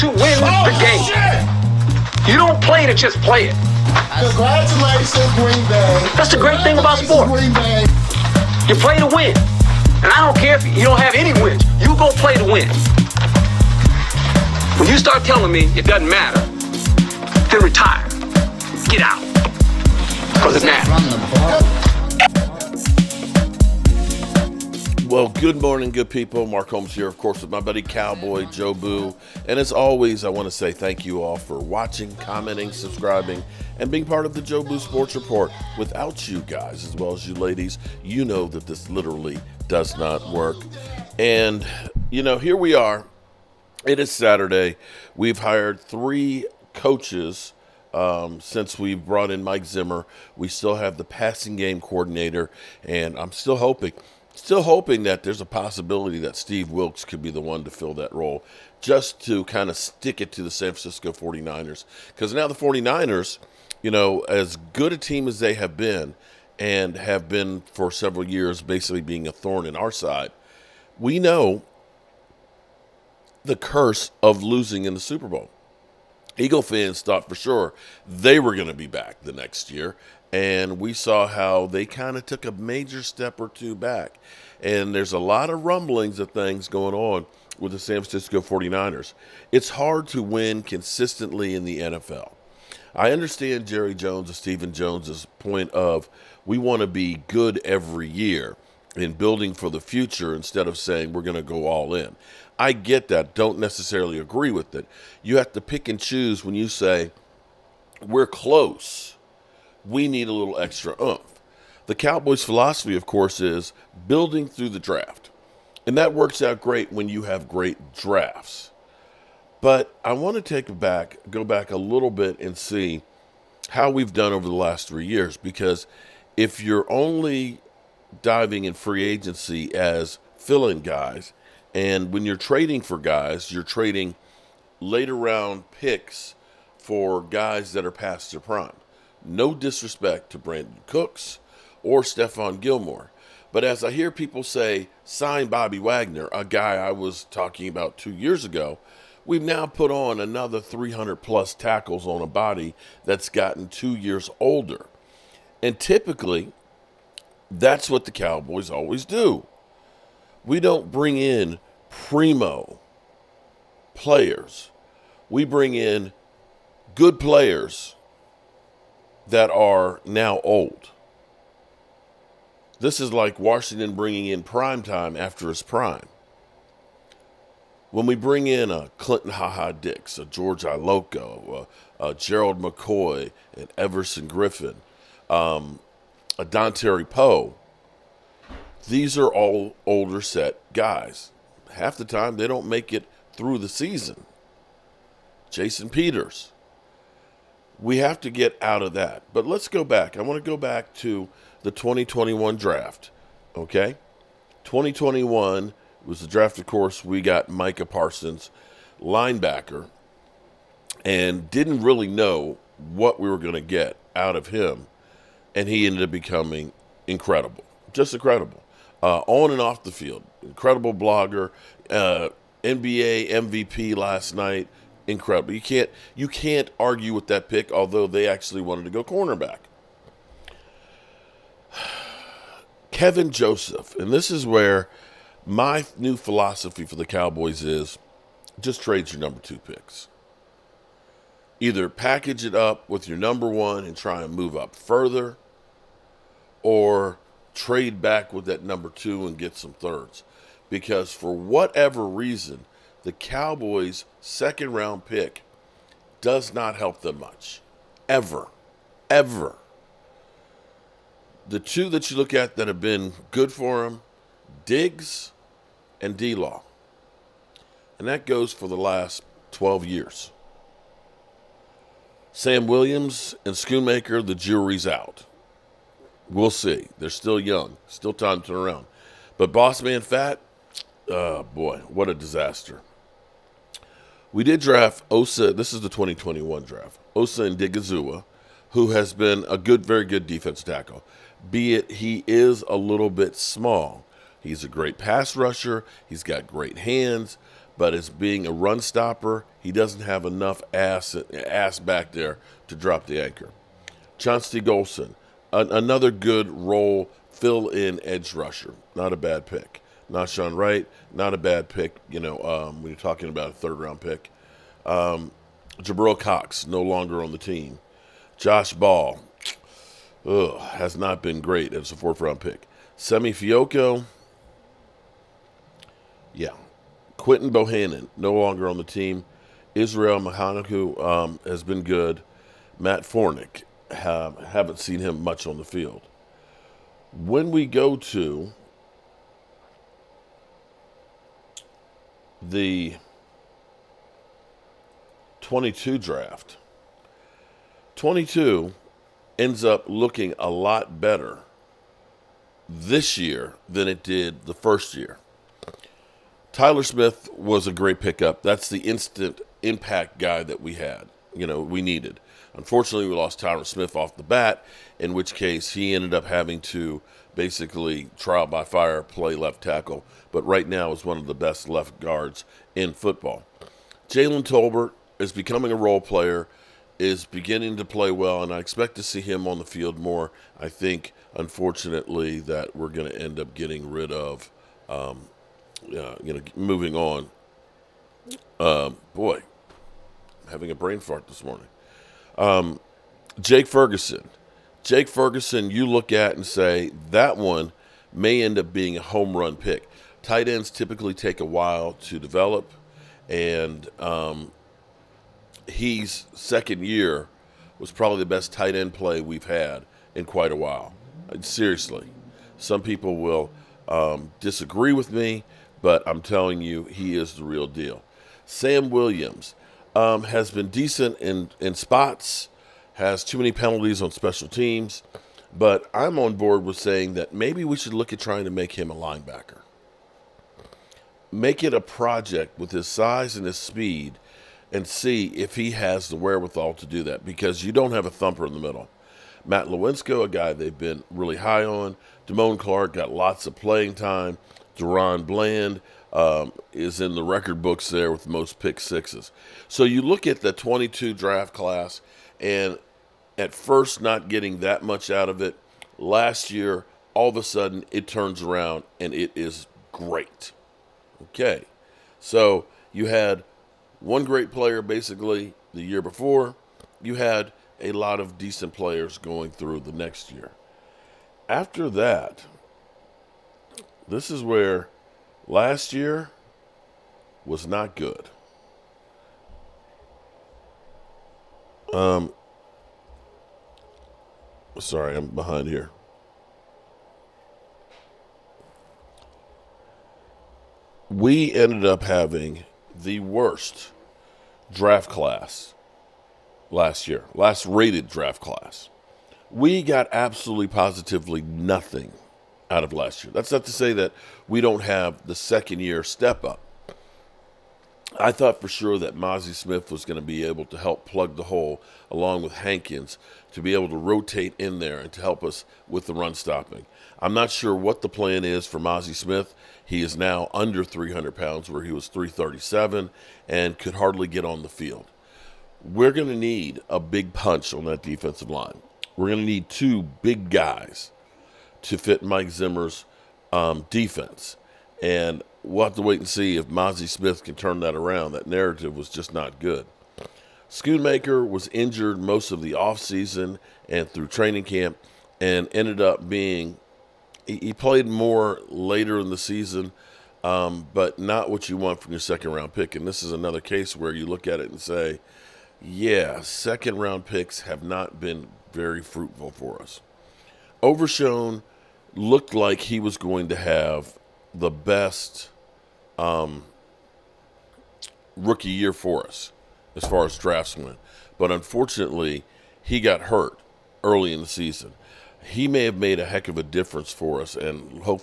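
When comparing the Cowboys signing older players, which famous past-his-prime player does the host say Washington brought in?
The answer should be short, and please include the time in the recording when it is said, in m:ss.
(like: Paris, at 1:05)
Prime Time, at 2:54.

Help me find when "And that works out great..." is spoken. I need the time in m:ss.
1:55.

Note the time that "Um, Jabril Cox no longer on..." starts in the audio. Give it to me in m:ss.
5:14.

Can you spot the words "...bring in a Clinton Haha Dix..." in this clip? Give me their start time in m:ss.
2:58.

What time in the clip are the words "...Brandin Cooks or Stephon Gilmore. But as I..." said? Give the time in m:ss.
2:20.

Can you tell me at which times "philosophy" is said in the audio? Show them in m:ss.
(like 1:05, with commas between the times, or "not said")
1:52, 3:56.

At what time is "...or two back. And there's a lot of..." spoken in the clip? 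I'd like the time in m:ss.
1:23.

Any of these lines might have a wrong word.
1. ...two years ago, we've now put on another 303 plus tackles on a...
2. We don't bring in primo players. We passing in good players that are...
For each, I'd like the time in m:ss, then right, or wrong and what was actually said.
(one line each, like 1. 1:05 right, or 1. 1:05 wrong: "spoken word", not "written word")
1. 2:27 wrong: "300", not "303"
2. 2:40 wrong: "bring", not "passing".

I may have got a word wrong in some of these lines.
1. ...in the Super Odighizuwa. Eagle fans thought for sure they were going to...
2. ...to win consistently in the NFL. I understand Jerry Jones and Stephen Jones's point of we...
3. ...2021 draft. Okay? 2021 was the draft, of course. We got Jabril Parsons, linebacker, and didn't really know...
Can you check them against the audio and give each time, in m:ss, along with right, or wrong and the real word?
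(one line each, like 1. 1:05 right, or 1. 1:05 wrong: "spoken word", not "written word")
1. 1:14 wrong: "Bowl", not "Odighizuwa"
2. 1:30 right
3. 3:21 wrong: "Micah", not "Jabril".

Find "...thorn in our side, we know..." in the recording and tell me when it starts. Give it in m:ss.
1:09.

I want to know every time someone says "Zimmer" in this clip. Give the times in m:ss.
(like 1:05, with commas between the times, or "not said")
0:49, 8:52.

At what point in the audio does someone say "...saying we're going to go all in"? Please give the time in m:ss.
1:40.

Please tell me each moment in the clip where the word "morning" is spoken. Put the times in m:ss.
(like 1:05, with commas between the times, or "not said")
0:25, 6:31.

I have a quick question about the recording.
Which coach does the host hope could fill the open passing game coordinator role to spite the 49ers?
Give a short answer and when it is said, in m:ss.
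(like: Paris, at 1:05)
Steve Wilks, at 0:56.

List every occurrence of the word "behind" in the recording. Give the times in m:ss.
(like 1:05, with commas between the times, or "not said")
8:05.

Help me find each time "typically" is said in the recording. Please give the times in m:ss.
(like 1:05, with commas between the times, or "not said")
2:35, 6:40.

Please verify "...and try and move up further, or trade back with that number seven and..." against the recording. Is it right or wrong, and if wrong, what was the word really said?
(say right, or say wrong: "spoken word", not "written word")
wrong: "two", not "seven".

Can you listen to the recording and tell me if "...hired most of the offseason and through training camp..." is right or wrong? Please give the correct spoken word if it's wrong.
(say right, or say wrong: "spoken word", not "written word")
wrong: "injured", not "hired".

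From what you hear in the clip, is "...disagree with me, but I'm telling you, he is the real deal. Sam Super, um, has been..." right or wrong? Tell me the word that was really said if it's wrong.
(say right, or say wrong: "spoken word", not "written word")
wrong: "Williams", not "Super".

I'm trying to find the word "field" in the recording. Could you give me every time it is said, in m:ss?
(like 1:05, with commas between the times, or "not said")
3:39, 5:35, 6:19, 8:44.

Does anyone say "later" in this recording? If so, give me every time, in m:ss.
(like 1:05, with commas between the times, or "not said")
2:14, 9:08.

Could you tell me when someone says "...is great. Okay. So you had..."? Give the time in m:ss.
7:39.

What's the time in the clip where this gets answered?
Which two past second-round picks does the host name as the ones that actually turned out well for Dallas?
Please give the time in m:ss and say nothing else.
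4:24.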